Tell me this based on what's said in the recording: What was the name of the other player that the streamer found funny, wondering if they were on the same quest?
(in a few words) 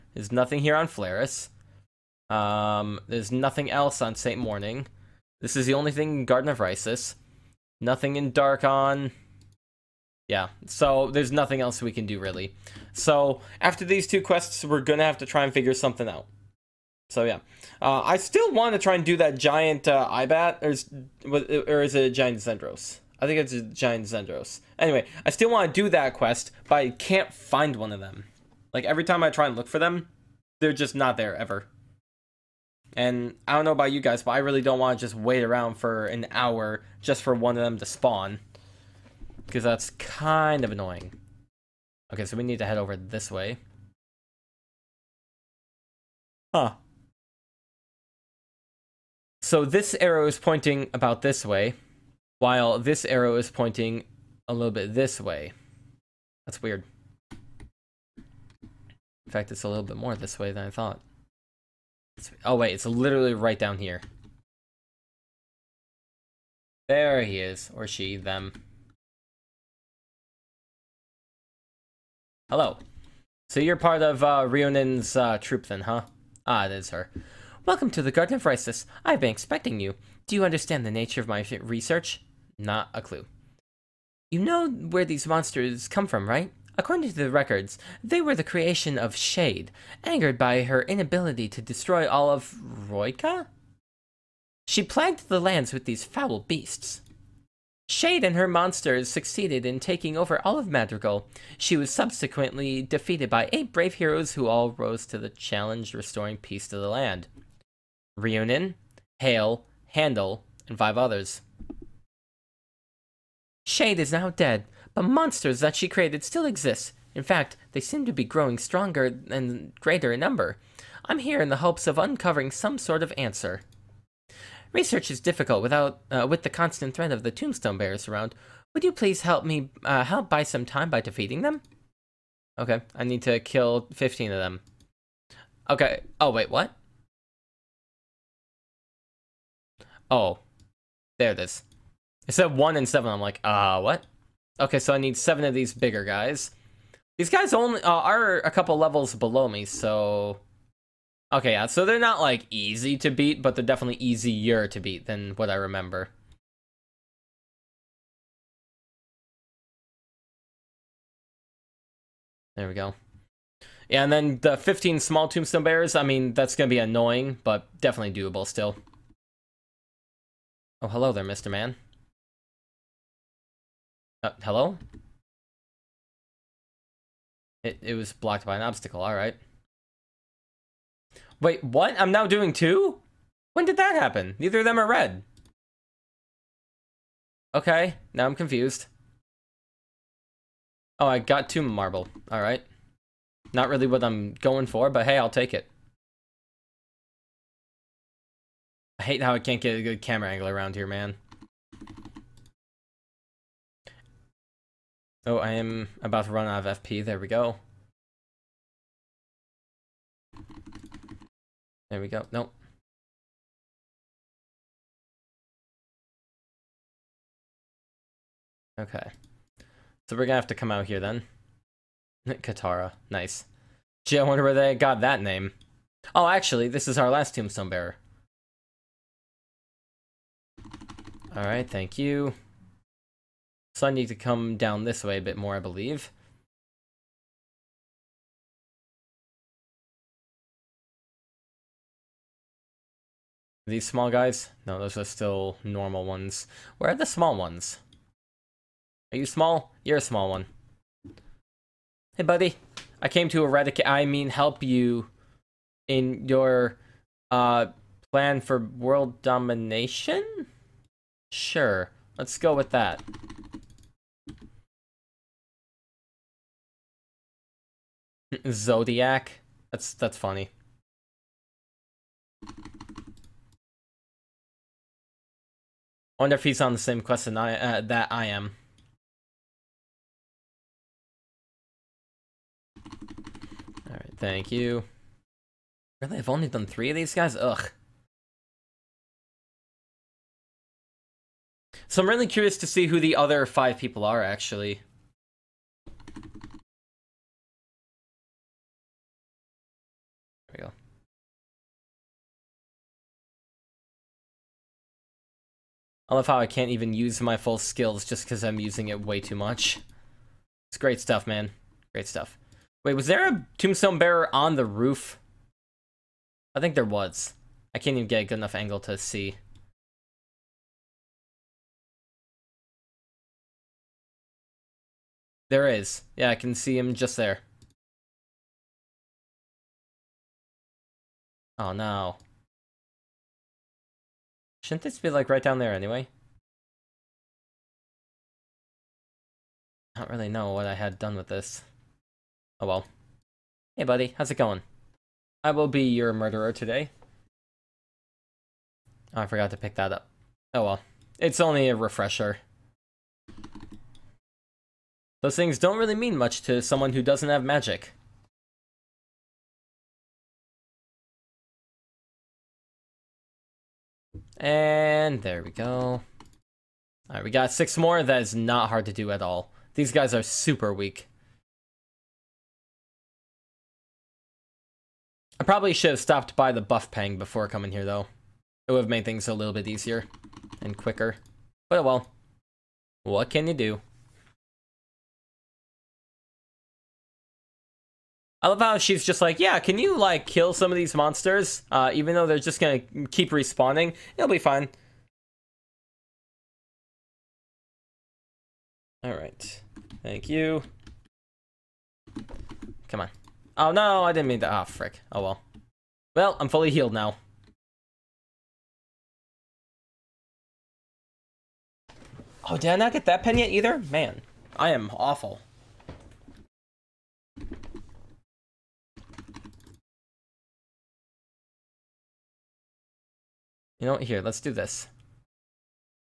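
Zodiac.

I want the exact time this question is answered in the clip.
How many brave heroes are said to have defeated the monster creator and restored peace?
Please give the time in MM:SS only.
01:43.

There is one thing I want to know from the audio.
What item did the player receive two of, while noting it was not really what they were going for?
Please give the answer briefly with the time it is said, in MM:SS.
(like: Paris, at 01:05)
Marble, at 03:11.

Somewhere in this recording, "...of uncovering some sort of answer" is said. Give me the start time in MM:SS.
02:01.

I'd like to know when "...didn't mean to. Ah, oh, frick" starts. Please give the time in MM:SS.
06:44.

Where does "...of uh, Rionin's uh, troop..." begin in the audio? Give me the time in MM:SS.
01:14.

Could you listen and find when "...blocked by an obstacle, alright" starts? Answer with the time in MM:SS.
02:58.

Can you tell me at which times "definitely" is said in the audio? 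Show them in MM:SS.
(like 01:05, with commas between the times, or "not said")
02:33, 02:47.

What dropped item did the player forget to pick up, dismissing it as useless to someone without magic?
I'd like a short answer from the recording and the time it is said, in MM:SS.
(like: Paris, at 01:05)
Refresher, at 05:51.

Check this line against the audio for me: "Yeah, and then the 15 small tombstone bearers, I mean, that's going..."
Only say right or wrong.
right.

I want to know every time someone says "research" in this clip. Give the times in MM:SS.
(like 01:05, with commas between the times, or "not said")
01:21, 02:04.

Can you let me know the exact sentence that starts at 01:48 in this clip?
Reunion, Hale, Handel, and five others.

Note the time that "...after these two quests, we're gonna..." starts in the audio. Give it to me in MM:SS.
00:13.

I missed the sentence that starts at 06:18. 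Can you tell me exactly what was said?
It would have made things a little bit easier and quicker.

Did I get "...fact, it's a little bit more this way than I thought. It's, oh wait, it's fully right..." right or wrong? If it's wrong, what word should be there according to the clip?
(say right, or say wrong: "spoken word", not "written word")
wrong: "literally", not "fully".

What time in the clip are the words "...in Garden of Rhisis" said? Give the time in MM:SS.
00:06.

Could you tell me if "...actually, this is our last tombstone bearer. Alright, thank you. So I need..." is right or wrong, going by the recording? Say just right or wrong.
right.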